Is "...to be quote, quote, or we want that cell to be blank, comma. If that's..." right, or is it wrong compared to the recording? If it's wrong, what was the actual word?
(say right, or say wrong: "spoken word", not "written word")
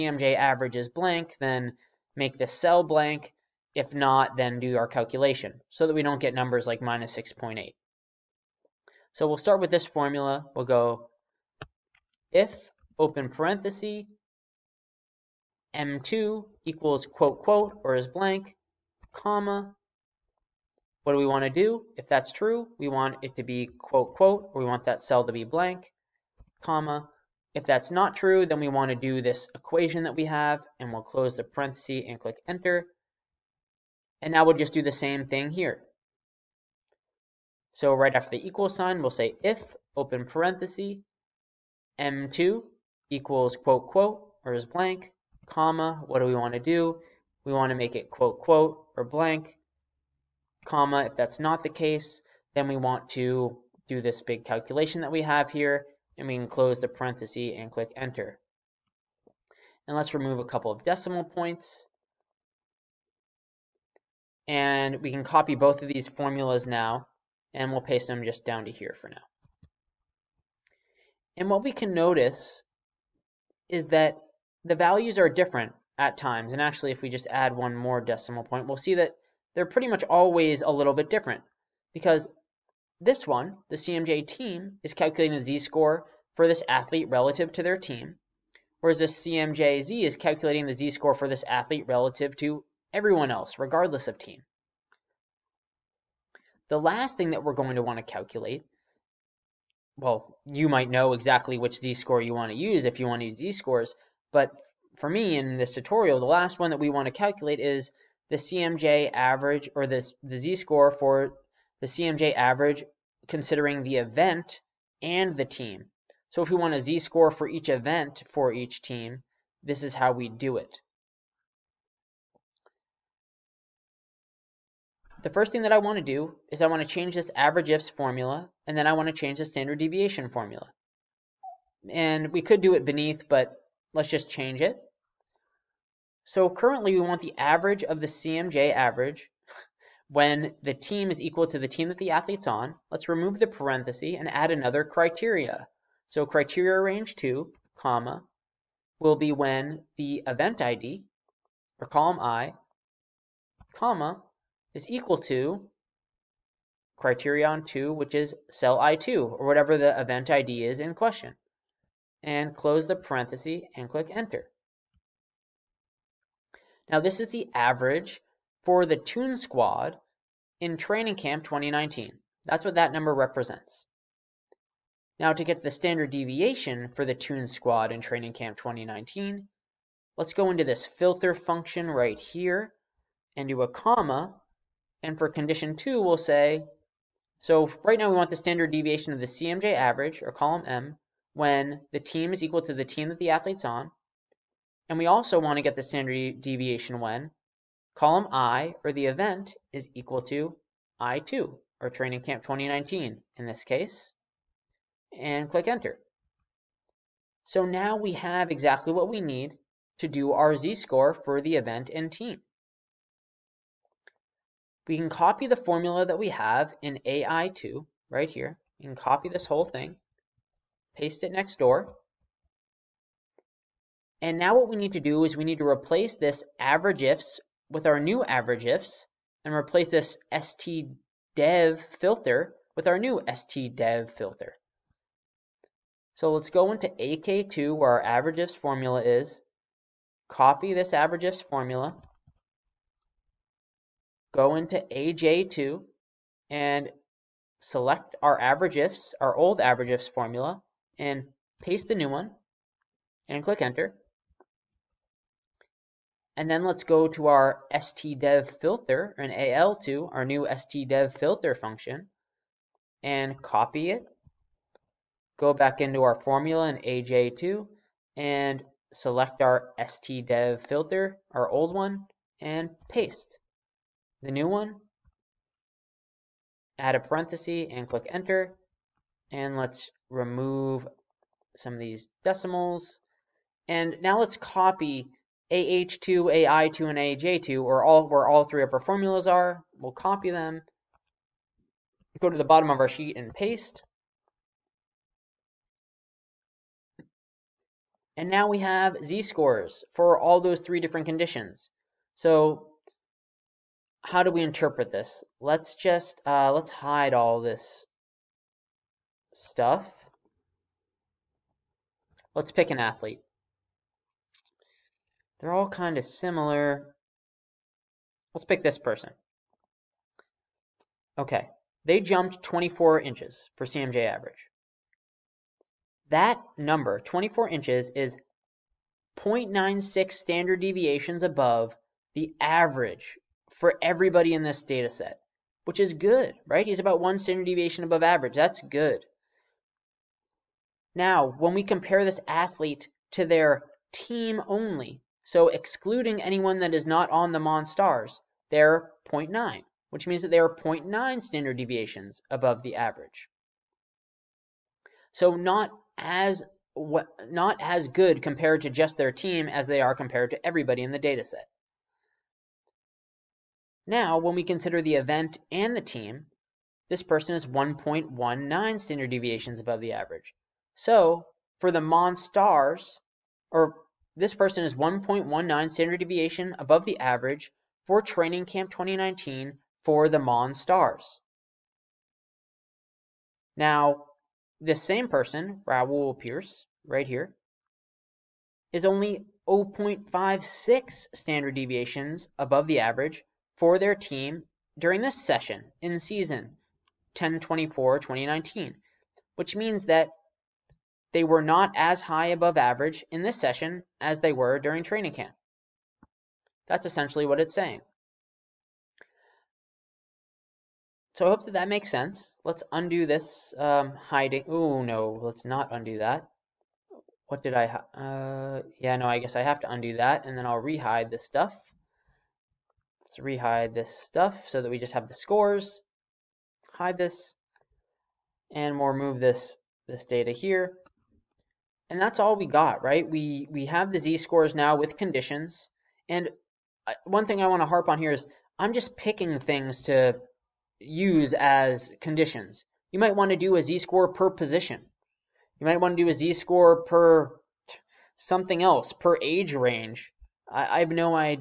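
right.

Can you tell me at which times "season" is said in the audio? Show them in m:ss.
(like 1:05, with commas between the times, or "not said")
6:35.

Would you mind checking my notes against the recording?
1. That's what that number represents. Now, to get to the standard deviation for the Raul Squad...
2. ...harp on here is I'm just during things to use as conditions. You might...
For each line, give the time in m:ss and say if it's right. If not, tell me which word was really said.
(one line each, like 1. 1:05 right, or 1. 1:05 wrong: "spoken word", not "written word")
1. 2:52 wrong: "Tune", not "Raul"
2. 7:17 wrong: "picking", not "during".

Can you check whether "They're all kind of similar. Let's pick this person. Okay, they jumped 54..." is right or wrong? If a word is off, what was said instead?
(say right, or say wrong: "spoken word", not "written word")
wrong: "24", not "54".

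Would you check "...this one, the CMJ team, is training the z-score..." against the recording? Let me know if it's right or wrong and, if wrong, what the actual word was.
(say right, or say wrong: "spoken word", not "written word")
wrong: "calculating", not "training".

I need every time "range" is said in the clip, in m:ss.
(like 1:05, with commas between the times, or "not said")
2:26, 7:29.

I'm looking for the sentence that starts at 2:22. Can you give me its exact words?
Let's remove the parenthesis and add another criteria.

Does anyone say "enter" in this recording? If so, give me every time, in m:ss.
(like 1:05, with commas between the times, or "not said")
0:32, 0:57, 2:44, 3:25, 4:13, 4:38.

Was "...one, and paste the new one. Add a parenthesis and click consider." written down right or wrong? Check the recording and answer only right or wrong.
wrong.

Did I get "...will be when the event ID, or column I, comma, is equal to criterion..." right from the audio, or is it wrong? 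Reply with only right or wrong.
right.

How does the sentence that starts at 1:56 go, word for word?
So if we want a z-score for each event for each team, this is how we do it.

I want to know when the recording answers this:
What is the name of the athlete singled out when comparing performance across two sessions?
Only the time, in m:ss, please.
6:25.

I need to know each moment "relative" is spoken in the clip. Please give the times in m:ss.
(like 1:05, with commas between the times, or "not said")
1:27, 1:31.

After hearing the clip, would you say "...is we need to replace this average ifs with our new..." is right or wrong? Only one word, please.
right.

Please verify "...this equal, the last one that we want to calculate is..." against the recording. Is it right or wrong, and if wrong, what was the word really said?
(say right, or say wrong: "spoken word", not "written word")
wrong: "tutorial", not "equal".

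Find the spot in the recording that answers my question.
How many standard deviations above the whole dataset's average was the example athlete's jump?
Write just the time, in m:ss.
5:29.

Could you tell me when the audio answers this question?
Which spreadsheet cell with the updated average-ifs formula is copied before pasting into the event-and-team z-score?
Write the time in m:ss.
3:56.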